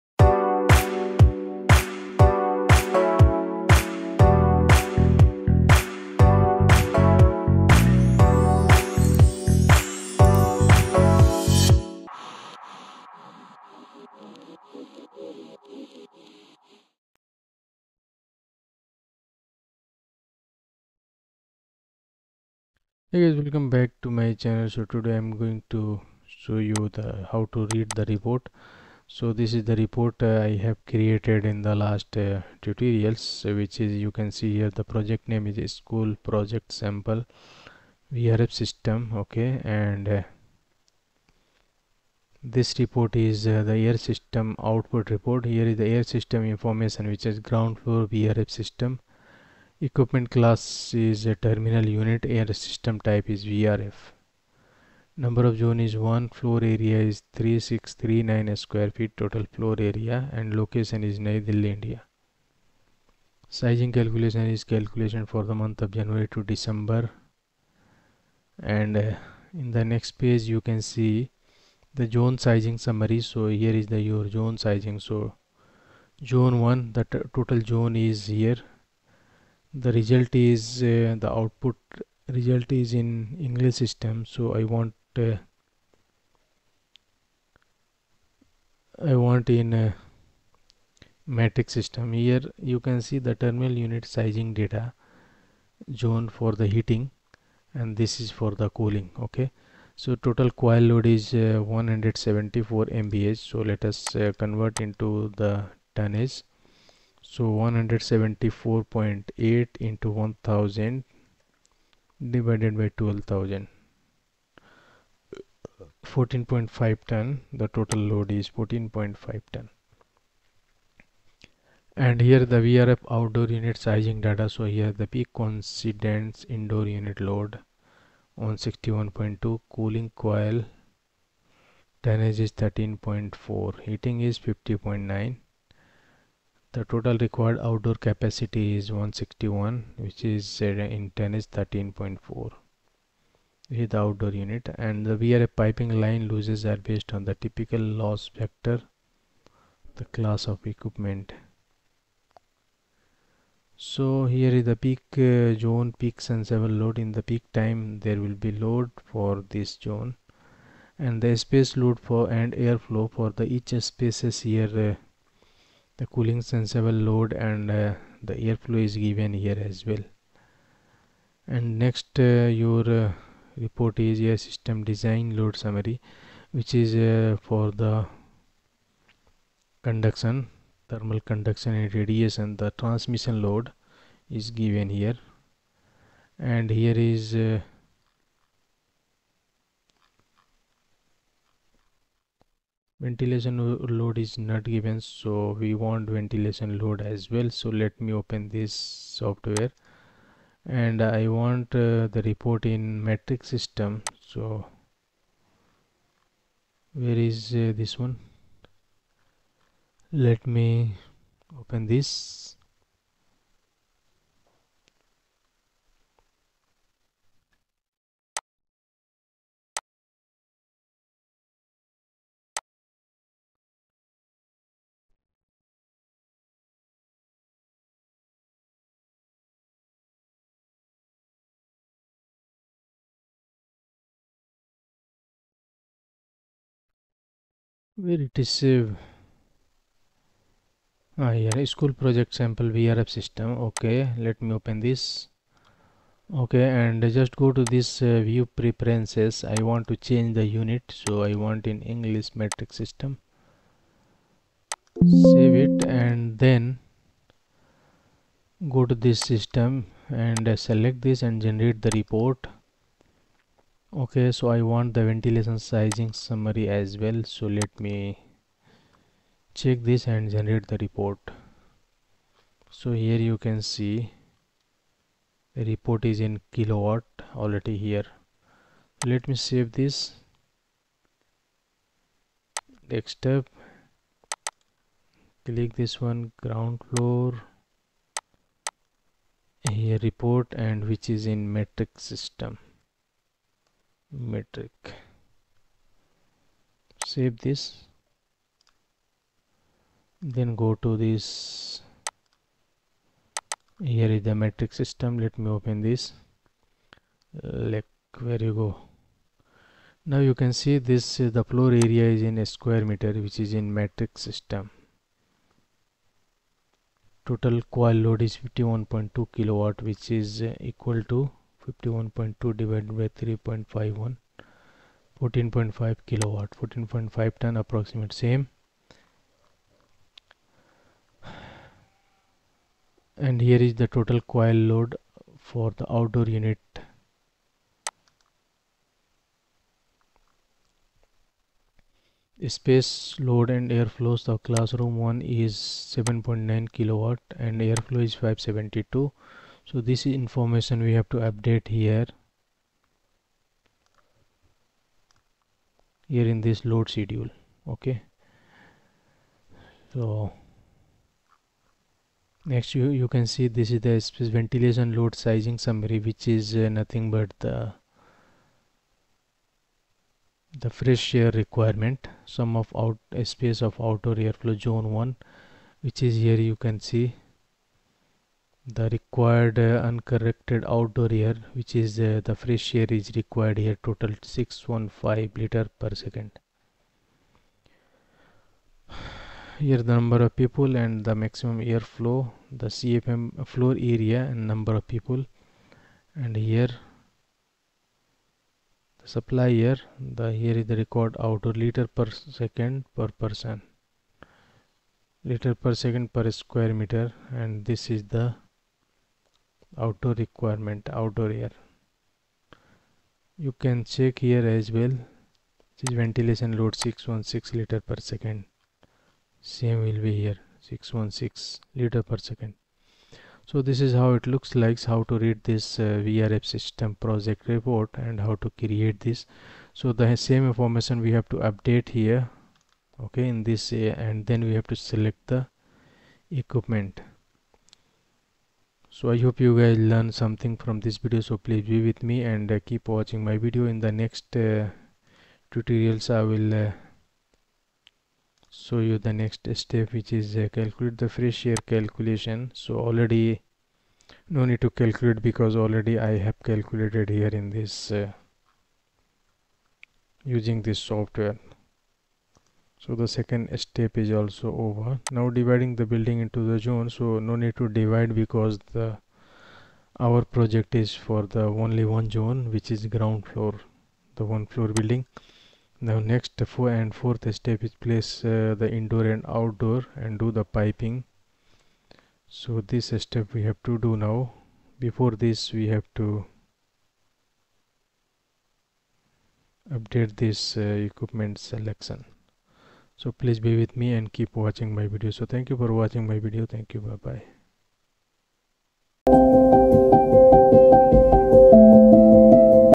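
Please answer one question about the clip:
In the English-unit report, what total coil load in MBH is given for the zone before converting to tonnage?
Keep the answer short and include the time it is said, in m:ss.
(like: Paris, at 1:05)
174.8 MBH, at 1:47.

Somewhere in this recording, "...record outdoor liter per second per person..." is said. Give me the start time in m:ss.
6:40.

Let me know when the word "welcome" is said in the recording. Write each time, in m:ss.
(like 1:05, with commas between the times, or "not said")
0:23.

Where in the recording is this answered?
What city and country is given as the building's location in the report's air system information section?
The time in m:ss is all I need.
1:01.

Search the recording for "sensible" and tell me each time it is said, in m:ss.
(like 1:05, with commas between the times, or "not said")
2:36, 2:46.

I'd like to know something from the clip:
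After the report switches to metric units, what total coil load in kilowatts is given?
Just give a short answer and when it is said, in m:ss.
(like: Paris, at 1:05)
51.2 kilowatt, at 5:18.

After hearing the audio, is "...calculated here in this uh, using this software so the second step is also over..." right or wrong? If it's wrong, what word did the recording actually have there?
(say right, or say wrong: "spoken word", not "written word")
right.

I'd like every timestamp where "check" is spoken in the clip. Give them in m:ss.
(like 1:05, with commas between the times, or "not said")
4:29, 6:53.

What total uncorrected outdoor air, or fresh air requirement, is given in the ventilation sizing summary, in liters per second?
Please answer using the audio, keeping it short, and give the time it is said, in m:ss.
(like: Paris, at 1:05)
615 liters per second, at 6:24.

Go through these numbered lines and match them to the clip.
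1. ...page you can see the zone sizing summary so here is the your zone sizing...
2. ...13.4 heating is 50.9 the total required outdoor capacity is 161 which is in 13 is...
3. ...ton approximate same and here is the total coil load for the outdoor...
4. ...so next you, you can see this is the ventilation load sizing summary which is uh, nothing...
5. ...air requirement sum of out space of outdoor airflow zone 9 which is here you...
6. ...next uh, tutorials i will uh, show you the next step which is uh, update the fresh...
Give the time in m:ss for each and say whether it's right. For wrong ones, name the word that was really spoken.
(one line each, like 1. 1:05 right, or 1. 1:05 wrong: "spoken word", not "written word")
1. 1:10 right
2. 2:12 wrong: "10", not "13"
3. 5:27 right
4. 5:59 right
5. 6:11 wrong: "1", not "9"
6. 7:23 wrong: "calculate", not "update".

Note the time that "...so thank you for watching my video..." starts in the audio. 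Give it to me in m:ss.
8:15.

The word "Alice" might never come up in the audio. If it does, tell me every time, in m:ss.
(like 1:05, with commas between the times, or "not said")
not said.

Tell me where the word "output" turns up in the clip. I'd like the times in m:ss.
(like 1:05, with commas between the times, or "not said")
0:44, 1:21.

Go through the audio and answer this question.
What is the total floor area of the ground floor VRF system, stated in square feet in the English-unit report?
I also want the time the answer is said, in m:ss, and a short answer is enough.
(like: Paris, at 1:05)
3639 square feet, at 0:57.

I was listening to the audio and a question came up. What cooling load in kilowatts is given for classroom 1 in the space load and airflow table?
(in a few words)
7.9 kilowatt.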